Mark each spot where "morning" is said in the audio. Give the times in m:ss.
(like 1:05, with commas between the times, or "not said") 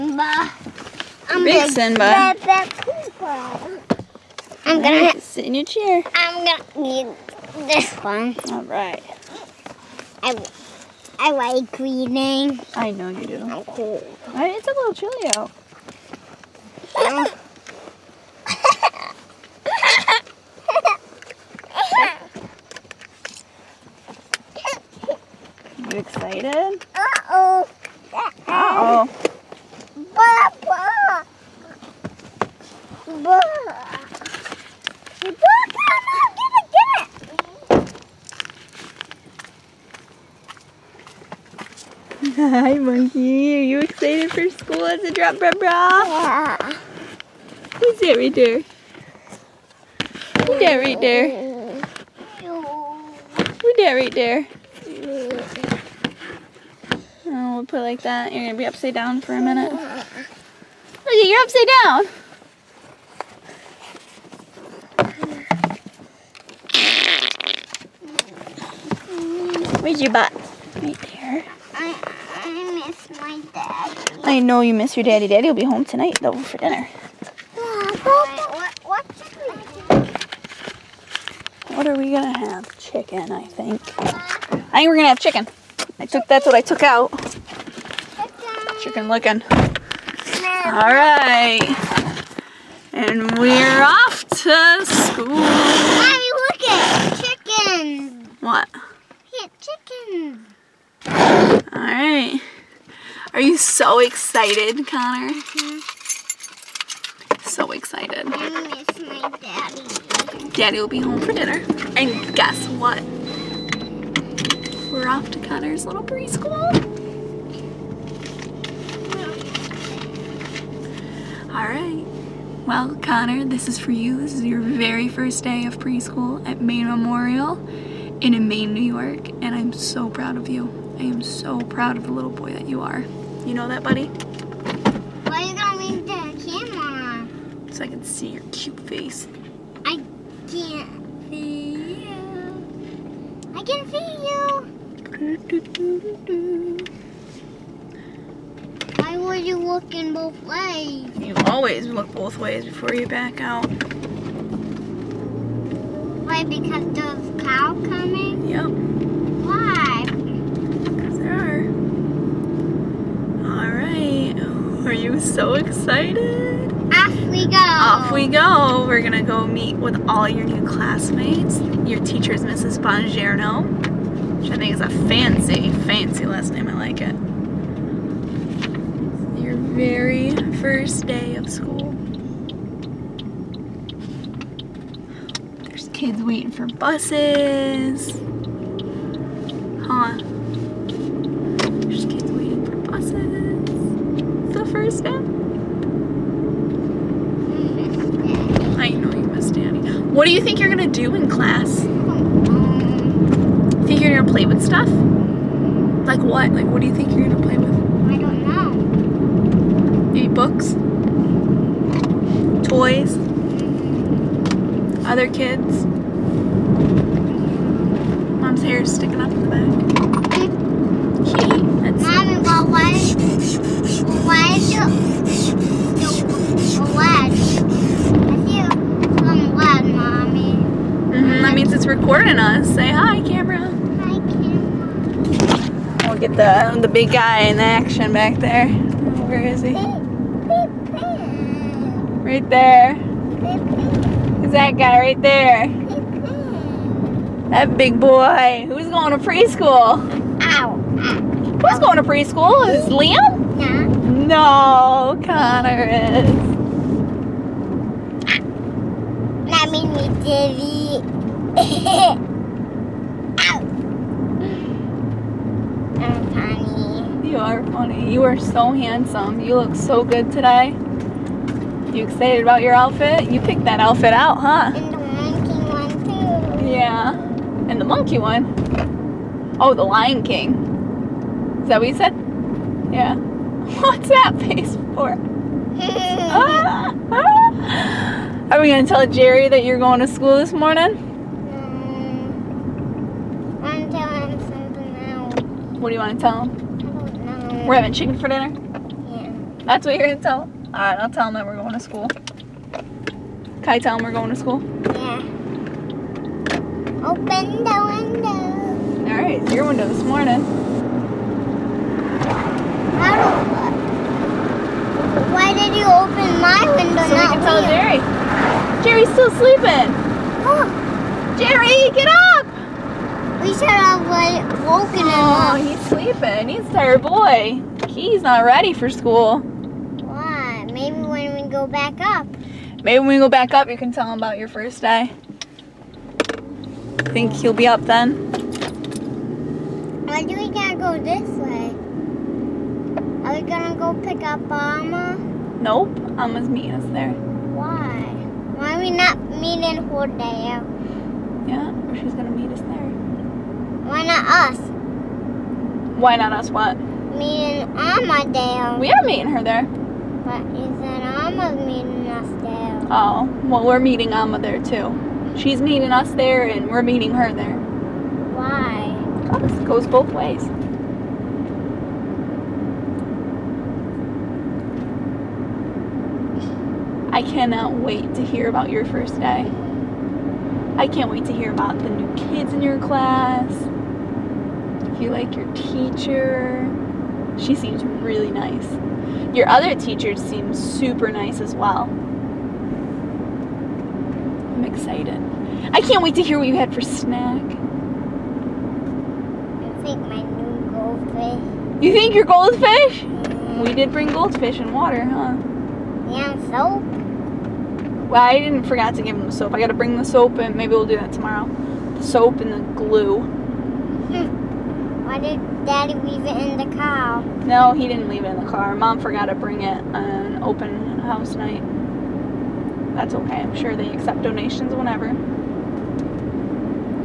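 4:50, 5:10.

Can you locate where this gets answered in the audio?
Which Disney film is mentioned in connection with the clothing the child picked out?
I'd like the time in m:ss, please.
4:39.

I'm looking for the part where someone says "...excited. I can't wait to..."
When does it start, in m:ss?
6:34.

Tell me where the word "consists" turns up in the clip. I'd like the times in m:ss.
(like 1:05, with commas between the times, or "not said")
not said.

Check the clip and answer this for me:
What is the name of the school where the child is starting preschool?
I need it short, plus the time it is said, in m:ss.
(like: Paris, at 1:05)
Maine Memorial, at 2:06.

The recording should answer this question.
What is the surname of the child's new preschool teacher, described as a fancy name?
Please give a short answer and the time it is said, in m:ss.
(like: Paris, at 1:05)
Mrs. Bongerno, at 2:52.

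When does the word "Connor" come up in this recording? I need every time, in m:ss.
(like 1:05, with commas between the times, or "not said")
1:44, 1:55, 2:02, 4:15.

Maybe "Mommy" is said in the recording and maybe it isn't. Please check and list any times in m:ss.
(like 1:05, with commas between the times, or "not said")
1:35, 4:19.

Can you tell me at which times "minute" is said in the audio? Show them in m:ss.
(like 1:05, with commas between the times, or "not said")
0:59.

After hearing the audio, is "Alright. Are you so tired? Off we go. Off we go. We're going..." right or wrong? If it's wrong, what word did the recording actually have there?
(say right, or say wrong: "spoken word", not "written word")
wrong: "excited", not "tired".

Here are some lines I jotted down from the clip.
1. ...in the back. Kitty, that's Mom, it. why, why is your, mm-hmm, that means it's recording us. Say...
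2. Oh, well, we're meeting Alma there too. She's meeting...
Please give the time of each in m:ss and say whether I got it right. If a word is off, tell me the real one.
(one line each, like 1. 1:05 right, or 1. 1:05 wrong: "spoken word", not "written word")
1. 3:39 right
2. 6:02 right.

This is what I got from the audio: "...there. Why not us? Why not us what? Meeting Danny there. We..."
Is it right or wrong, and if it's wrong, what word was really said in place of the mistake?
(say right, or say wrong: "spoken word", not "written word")
wrong: "Alma", not "Danny".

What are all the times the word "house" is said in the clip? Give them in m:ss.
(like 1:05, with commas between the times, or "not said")
7:00.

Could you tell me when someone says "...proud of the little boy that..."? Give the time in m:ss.
2:11.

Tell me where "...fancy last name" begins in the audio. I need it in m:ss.
2:55.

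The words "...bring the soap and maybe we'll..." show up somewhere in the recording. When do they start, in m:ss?
6:49.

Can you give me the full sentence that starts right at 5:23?
We should have like woken him oh, up.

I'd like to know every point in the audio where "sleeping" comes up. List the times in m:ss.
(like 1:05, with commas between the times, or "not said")
5:19, 5:25.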